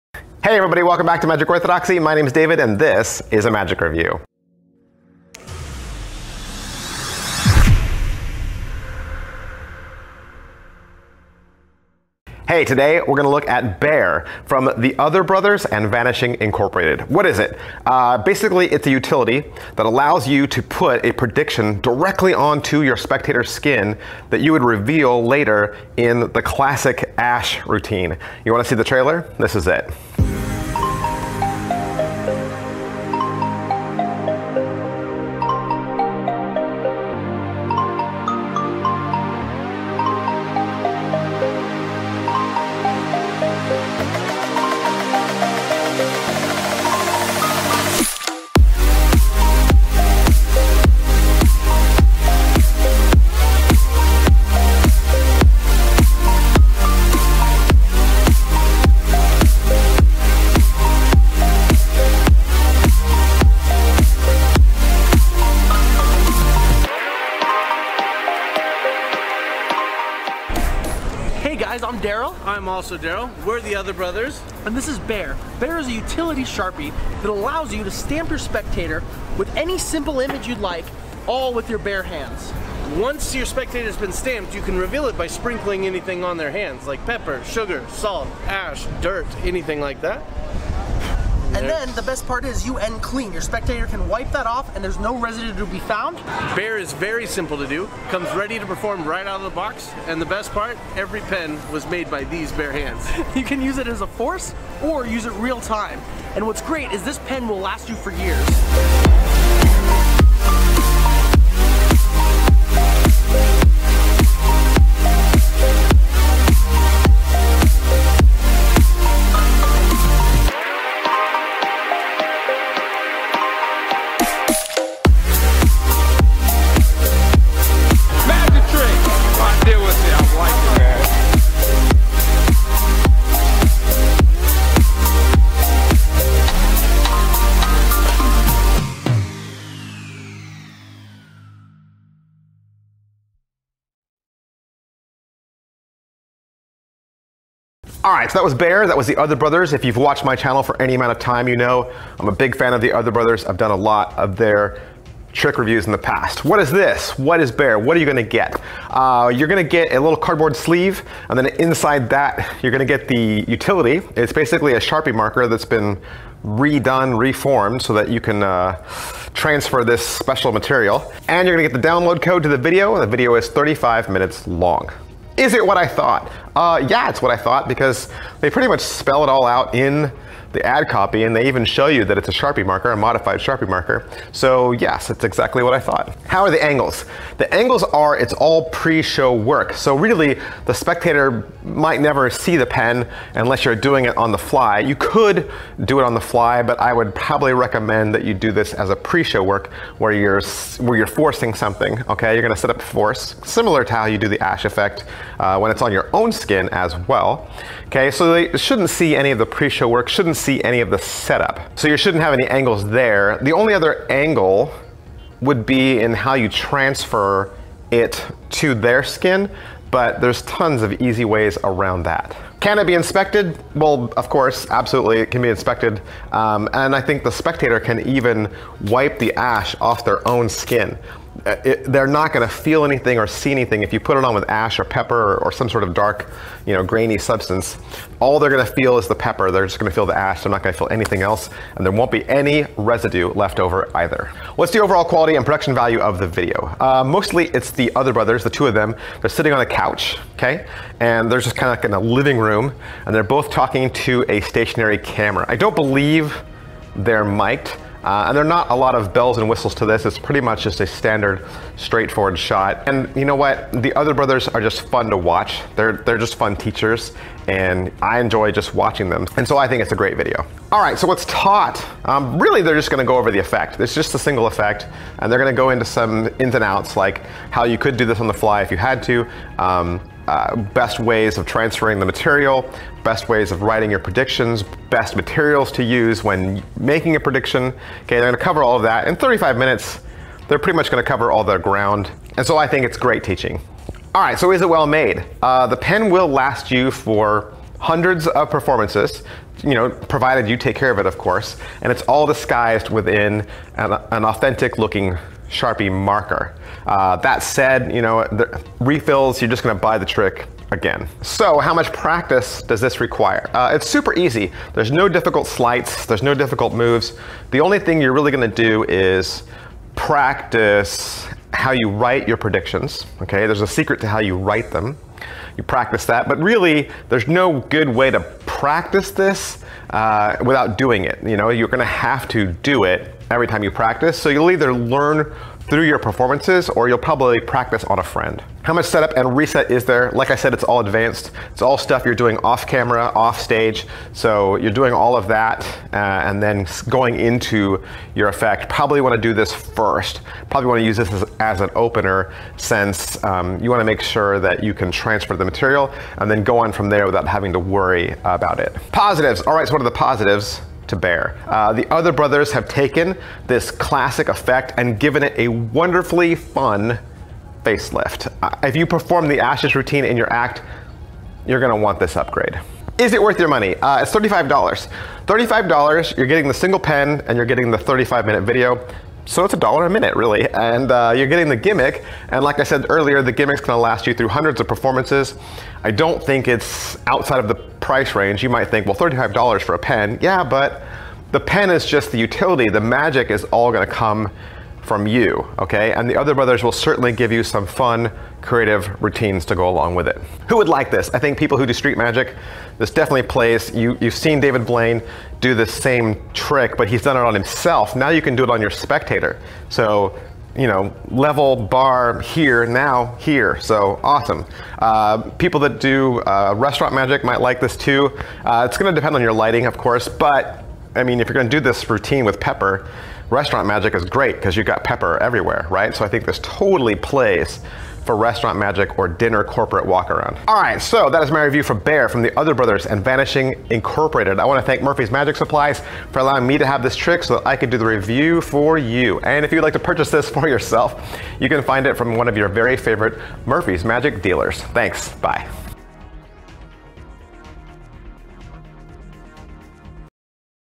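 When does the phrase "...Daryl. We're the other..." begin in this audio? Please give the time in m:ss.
1:12.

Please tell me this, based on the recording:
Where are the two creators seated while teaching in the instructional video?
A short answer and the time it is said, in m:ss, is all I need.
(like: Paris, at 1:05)
On a couch, at 4:09.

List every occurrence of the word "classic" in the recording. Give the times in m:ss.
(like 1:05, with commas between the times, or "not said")
0:26, 6:03.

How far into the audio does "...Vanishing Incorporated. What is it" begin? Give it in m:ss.
0:15.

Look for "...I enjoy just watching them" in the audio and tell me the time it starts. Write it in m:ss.
4:28.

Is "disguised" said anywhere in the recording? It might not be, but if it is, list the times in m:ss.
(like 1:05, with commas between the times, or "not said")
5:02.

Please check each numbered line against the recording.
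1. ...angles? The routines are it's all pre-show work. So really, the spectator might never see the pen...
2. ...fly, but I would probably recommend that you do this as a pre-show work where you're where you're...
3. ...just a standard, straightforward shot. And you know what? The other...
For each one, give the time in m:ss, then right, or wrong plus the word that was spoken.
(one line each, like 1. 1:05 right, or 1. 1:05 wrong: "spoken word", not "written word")
1. 3:06 wrong: "angles", not "routines"
2. 3:16 right
3. 4:20 right.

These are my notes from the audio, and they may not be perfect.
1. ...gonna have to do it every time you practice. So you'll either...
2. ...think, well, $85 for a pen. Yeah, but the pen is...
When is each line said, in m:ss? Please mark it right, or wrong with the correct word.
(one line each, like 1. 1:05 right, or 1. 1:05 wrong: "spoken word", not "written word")
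1. 5:31 right
2. 6:28 wrong: "35", not "85".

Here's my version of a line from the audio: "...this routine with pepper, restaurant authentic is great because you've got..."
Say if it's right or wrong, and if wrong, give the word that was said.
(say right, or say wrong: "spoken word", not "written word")
wrong: "magic", not "authentic".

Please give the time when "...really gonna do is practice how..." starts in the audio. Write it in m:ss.
5:18.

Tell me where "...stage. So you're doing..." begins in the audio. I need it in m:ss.
5:43.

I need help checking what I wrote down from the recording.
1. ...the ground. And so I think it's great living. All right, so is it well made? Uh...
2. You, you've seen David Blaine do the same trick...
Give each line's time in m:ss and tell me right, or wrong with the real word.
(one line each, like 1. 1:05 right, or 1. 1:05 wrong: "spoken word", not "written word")
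1. 4:51 wrong: "teaching", not "living"
2. 6:43 right.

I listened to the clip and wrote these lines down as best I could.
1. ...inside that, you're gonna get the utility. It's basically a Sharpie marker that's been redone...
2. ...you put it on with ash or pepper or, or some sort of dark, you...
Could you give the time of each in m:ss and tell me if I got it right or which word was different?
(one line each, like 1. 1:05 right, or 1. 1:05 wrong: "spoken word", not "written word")
1. 2:41 right
2. 3:53 right.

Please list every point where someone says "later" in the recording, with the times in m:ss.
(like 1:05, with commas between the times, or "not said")
0:25.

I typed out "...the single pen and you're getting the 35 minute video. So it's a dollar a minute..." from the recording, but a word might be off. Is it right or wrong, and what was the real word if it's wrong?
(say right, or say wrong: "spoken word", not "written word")
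right.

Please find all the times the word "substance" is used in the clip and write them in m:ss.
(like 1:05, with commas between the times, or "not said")
3:57.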